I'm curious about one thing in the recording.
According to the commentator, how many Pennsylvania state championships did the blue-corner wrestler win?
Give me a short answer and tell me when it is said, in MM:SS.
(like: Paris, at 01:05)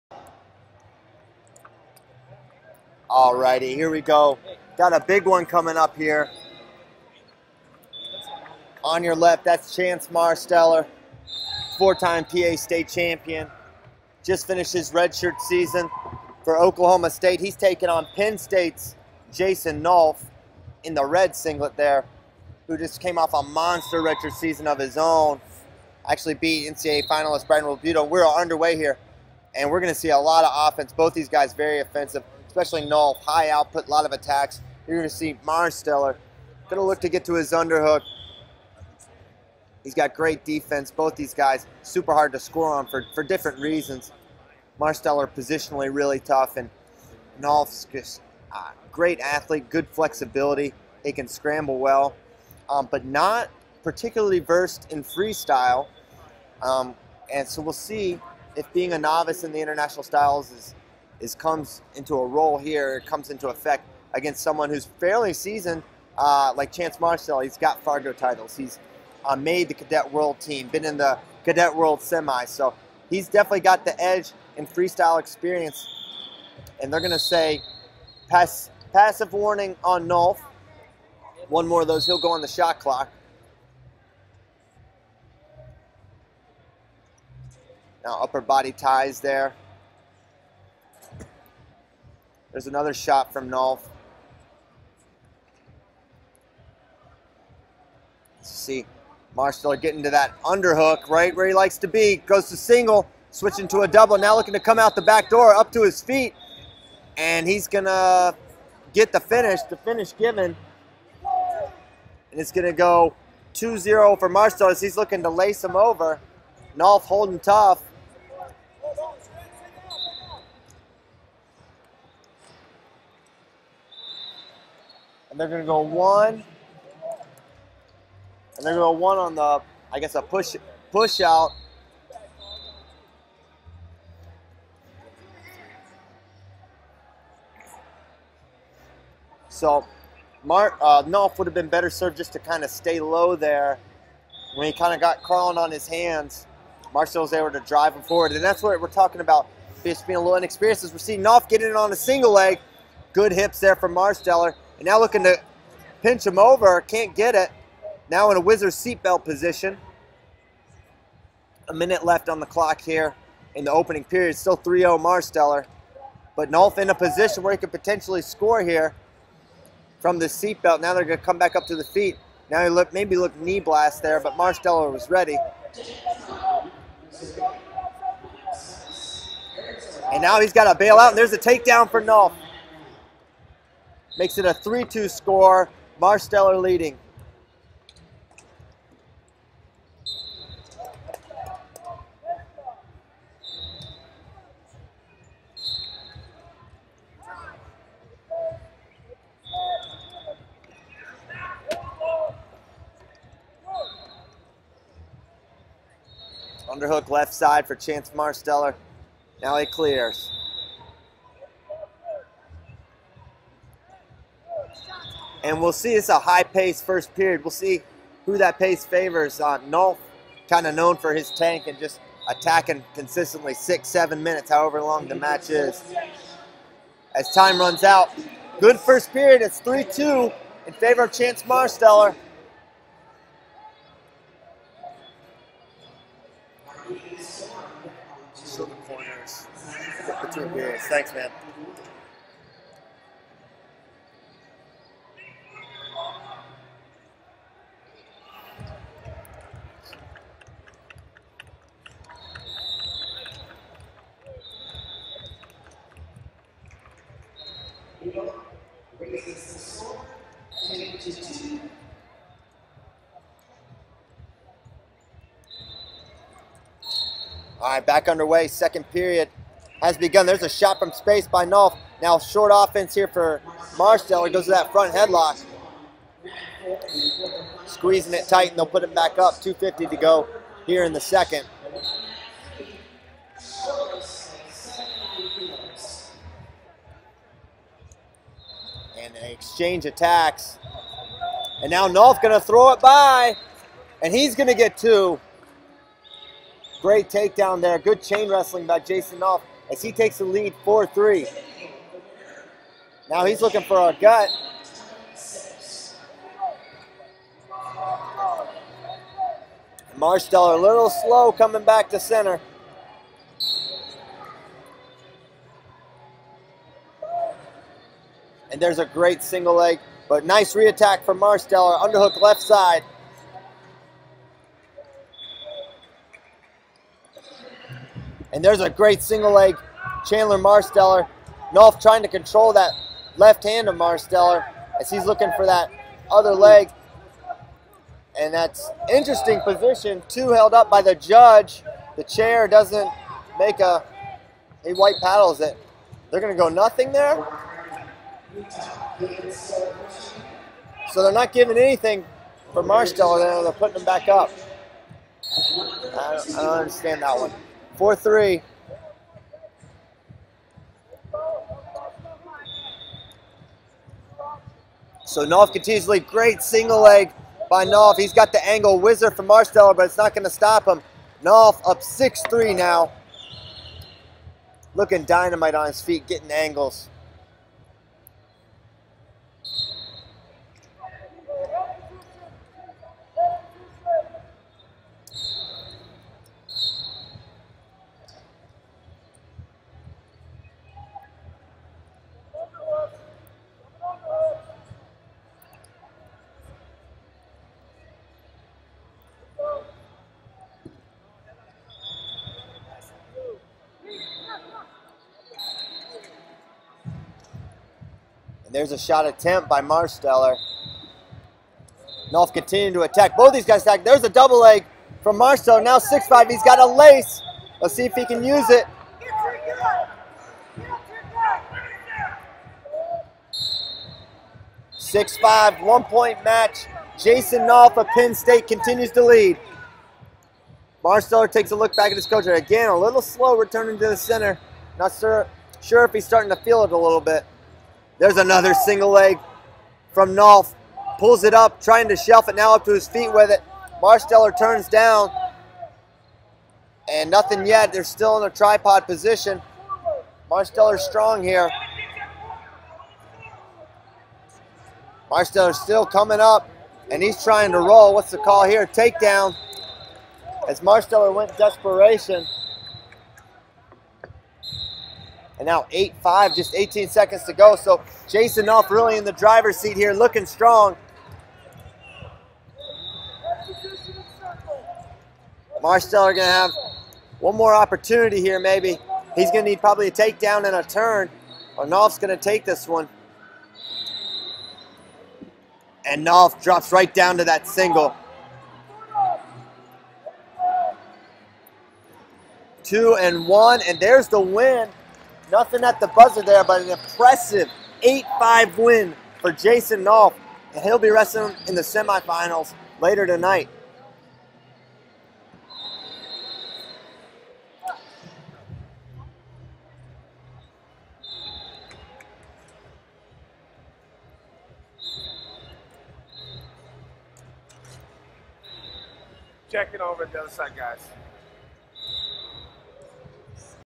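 4, at 00:11.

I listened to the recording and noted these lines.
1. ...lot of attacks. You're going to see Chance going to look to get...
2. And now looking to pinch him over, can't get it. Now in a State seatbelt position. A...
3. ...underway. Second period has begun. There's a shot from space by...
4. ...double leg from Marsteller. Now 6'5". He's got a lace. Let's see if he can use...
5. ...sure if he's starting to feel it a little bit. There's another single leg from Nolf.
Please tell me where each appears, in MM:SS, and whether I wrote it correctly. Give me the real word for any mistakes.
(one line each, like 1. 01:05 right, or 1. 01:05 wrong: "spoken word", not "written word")
1. 00:33 wrong: "Marsteller", not "Chance"
2. 02:34 wrong: "Wizards", not "State"
3. 04:28 right
4. 06:54 right
5. 07:15 right.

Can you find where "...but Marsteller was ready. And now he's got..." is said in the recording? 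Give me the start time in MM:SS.
02:54.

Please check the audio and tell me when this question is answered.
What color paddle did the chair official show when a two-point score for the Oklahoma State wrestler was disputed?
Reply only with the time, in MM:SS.
05:44.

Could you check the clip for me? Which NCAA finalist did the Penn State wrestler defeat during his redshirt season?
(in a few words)
Brian Realbuto.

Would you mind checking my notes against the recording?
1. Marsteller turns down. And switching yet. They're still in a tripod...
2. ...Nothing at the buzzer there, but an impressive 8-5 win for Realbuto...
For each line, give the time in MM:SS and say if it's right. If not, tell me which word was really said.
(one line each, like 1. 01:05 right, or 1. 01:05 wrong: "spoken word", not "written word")
1. 07:23 wrong: "nothing", not "switching"
2. 08:15 wrong: "Jason", not "Realbuto".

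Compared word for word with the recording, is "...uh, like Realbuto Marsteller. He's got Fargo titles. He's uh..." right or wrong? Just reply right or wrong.
wrong.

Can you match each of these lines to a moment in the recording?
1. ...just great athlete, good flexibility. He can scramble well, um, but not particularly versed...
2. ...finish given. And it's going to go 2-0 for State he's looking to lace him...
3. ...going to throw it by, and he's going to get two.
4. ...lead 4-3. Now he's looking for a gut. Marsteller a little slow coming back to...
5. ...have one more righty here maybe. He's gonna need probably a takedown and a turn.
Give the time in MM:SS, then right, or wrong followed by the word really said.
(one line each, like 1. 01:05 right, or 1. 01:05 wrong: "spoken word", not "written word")
1. 00:47 right
2. 01:49 wrong: "Marsteller", not "State"
3. 04:52 right
4. 05:00 right
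5. 07:56 wrong: "opportunity", not "righty".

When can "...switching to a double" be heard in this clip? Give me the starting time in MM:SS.
01:43.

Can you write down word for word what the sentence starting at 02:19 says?
So, Mark uh, Nolf would have been better served just to kind of stay low there.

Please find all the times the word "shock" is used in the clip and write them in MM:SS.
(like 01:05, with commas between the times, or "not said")
not said.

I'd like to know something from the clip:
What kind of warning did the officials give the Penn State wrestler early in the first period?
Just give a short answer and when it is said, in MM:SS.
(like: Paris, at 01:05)
Passive warning, at 01:18.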